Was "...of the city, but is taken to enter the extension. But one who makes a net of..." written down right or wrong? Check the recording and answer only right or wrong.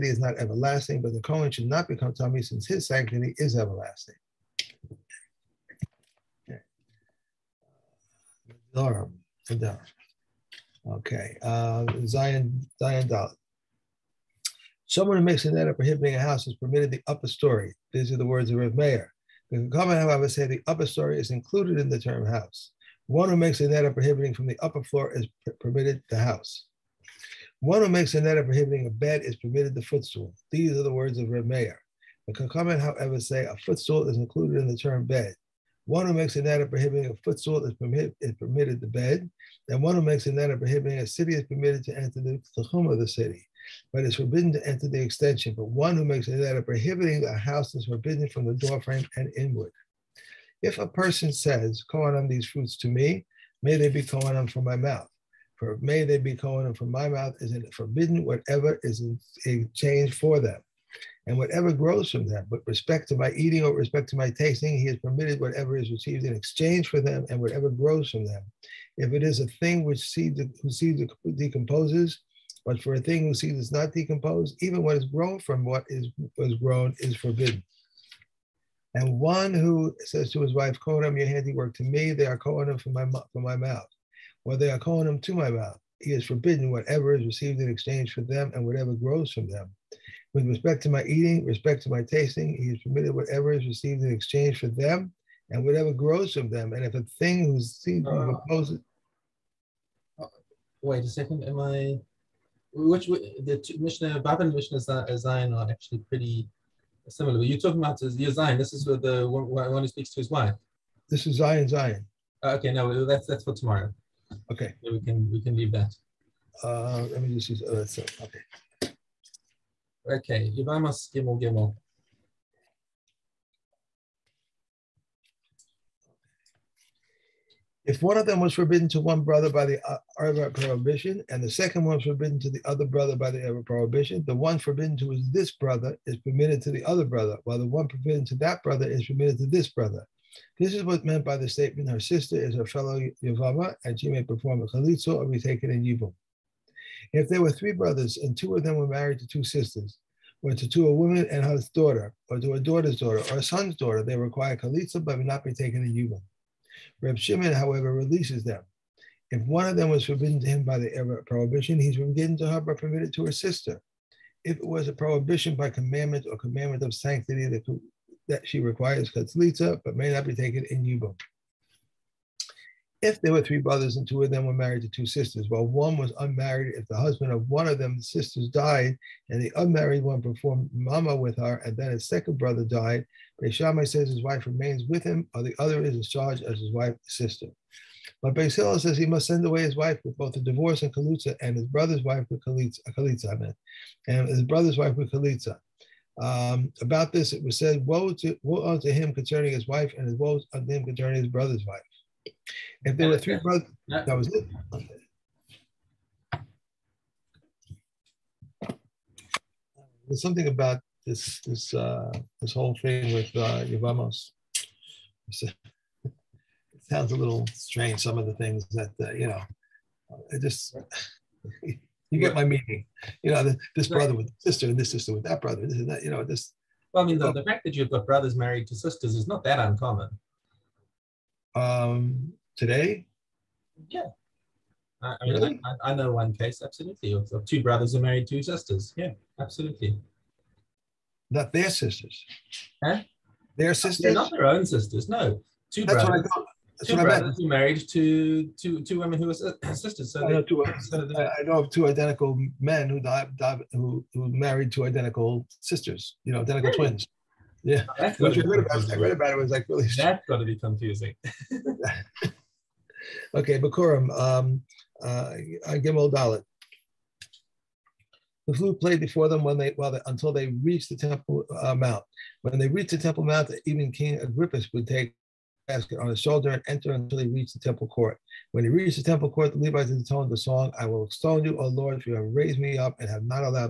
wrong.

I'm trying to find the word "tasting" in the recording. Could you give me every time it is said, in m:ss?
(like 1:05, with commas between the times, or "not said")
1:04, 1:32.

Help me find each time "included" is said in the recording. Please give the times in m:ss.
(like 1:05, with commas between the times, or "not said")
0:21, 0:34.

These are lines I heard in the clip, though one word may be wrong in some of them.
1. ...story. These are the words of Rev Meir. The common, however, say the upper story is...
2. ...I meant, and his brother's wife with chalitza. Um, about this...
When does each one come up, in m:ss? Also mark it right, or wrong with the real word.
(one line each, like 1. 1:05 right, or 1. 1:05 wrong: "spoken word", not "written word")
1. 0:17 right
2. 3:13 right.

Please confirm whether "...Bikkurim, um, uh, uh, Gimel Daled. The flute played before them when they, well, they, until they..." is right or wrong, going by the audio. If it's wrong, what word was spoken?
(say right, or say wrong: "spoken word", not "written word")
right.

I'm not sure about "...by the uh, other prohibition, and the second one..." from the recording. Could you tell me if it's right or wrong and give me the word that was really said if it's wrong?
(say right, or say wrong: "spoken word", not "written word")
right.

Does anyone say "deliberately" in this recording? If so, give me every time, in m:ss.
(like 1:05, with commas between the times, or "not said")
not said.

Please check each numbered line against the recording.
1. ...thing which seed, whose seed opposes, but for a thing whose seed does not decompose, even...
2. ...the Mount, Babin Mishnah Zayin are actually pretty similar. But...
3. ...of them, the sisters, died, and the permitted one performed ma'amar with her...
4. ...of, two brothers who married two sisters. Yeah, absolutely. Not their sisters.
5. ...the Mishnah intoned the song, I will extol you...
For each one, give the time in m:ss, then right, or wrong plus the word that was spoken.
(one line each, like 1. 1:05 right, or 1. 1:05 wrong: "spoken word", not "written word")
1. 1:09 wrong: "decomposes", not "opposes"
2. 1:43 wrong: "Mishnah", not "Mount"
3. 2:57 wrong: "unmarried", not "permitted"
4. 3:57 right
5. 4:39 wrong: "Levites", not "Mishnah".